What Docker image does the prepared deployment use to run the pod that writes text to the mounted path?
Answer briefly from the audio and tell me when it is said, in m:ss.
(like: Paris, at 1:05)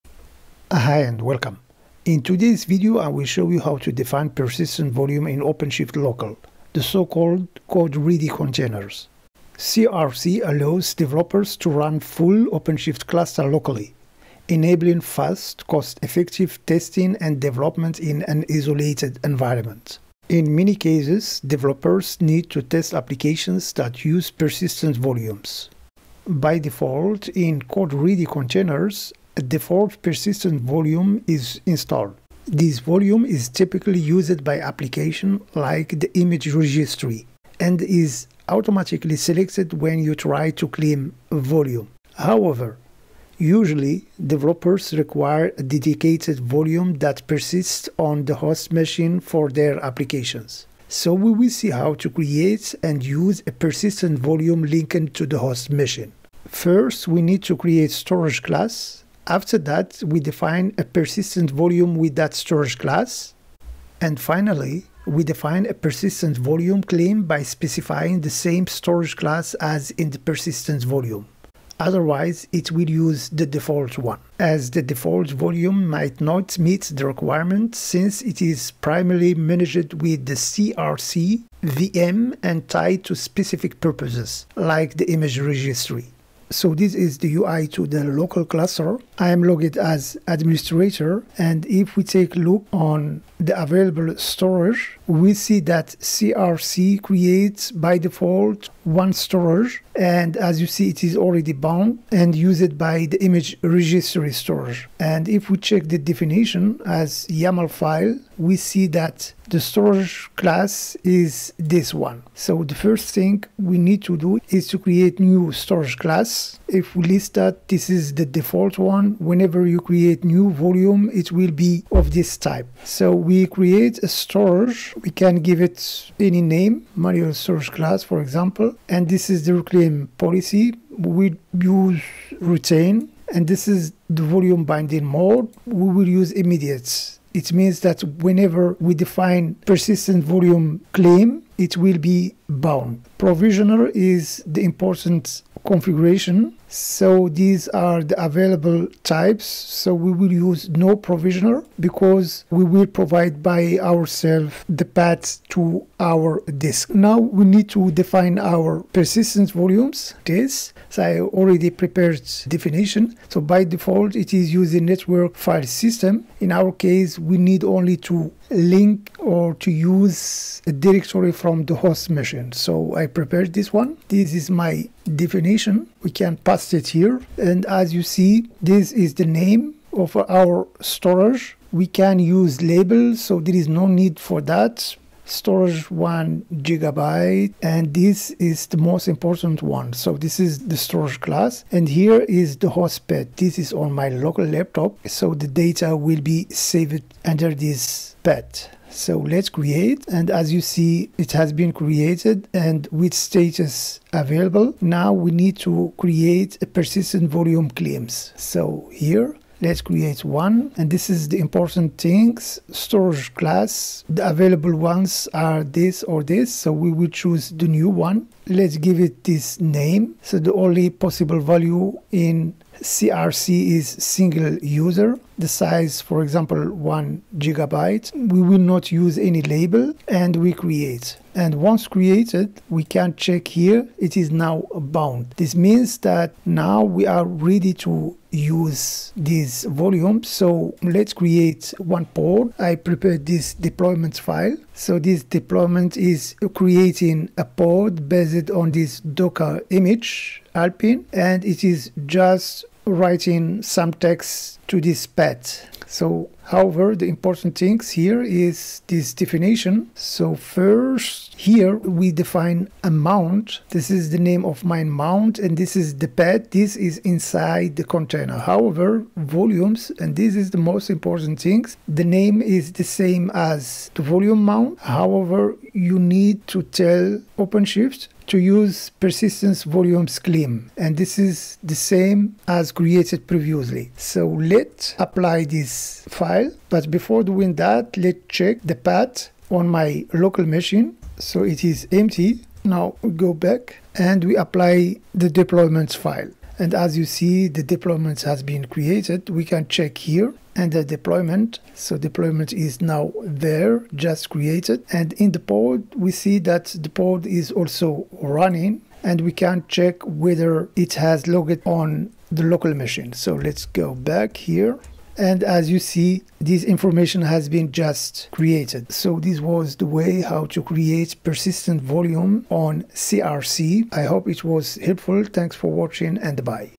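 Alpine, at 4:10.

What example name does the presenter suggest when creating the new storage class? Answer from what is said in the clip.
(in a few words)
manual storage class.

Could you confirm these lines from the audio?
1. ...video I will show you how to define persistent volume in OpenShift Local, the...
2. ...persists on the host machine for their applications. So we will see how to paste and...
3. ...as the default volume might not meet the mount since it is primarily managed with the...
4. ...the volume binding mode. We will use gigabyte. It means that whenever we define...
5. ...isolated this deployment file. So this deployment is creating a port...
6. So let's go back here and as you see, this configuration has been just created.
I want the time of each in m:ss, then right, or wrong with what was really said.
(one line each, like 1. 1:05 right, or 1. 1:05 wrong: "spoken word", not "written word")
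1. 0:02 right
2. 0:47 wrong: "create", not "paste"
3. 1:14 wrong: "requirement", not "mount"
4. 2:14 wrong: "immediate", not "gigabyte"
5. 4:02 wrong: "prepared", not "isolated"
6. 5:13 wrong: "information", not "configuration".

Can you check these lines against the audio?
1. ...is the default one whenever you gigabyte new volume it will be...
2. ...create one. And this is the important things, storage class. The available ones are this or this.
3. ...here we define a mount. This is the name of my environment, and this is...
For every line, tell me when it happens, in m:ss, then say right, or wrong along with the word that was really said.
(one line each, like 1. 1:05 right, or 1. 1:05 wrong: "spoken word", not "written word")
1. 1:57 wrong: "create", not "gigabyte"
2. 3:29 right
3. 4:21 wrong: "mount", not "environment".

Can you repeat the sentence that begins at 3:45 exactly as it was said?
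The size, for example, one gigabyte.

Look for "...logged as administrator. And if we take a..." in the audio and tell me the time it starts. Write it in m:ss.
1:29.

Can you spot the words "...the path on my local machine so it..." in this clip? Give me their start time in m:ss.
4:48.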